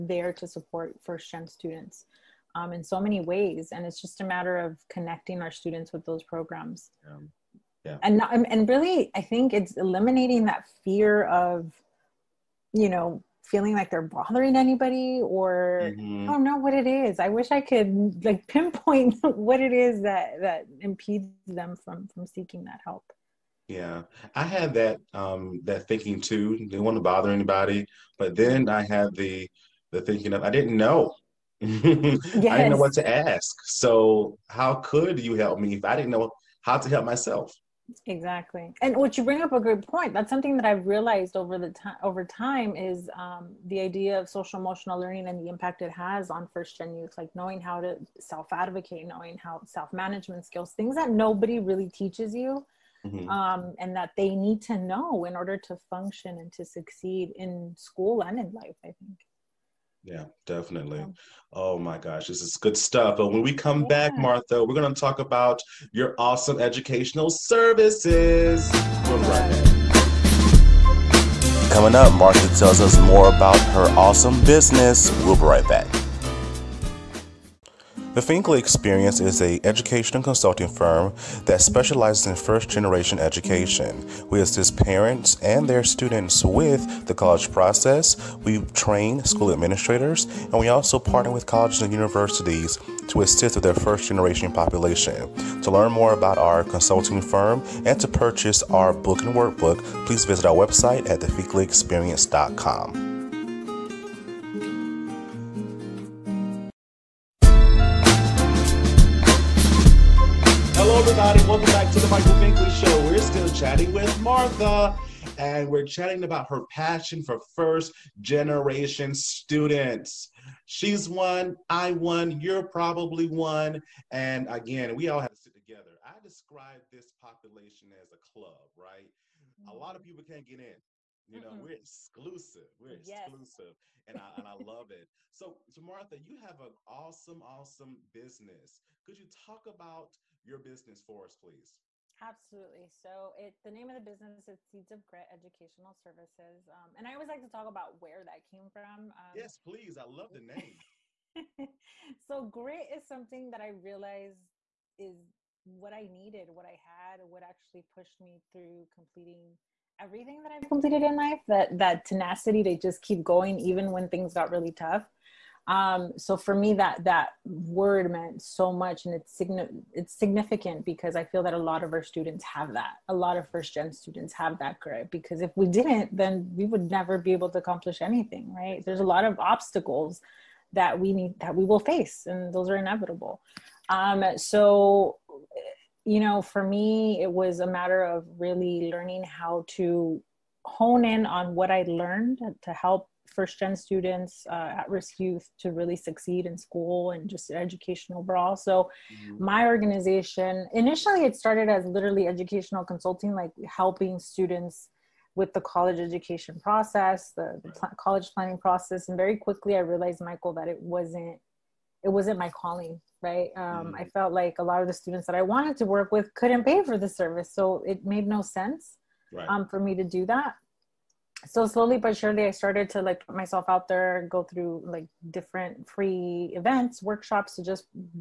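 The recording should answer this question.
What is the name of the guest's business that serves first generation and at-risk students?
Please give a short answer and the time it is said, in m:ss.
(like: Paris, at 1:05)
Seeds of Grit Educational Services, at 2:24.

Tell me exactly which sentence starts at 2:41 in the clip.
That that tenacity to just keep going, even when things got really tough.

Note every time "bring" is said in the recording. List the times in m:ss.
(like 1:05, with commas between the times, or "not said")
0:39.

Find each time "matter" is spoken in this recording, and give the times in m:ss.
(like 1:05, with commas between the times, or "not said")
0:04, 3:07.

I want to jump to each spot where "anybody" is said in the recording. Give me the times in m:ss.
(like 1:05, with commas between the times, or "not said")
0:14, 0:27.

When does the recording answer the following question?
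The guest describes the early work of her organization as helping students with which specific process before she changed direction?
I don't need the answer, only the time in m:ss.
3:27.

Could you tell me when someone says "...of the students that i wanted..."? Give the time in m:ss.
3:34.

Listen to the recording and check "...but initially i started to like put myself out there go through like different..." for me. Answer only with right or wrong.
wrong.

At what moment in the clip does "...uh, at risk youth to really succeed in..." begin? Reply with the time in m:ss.
3:14.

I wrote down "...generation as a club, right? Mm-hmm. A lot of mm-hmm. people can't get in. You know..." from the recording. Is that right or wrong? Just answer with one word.
wrong.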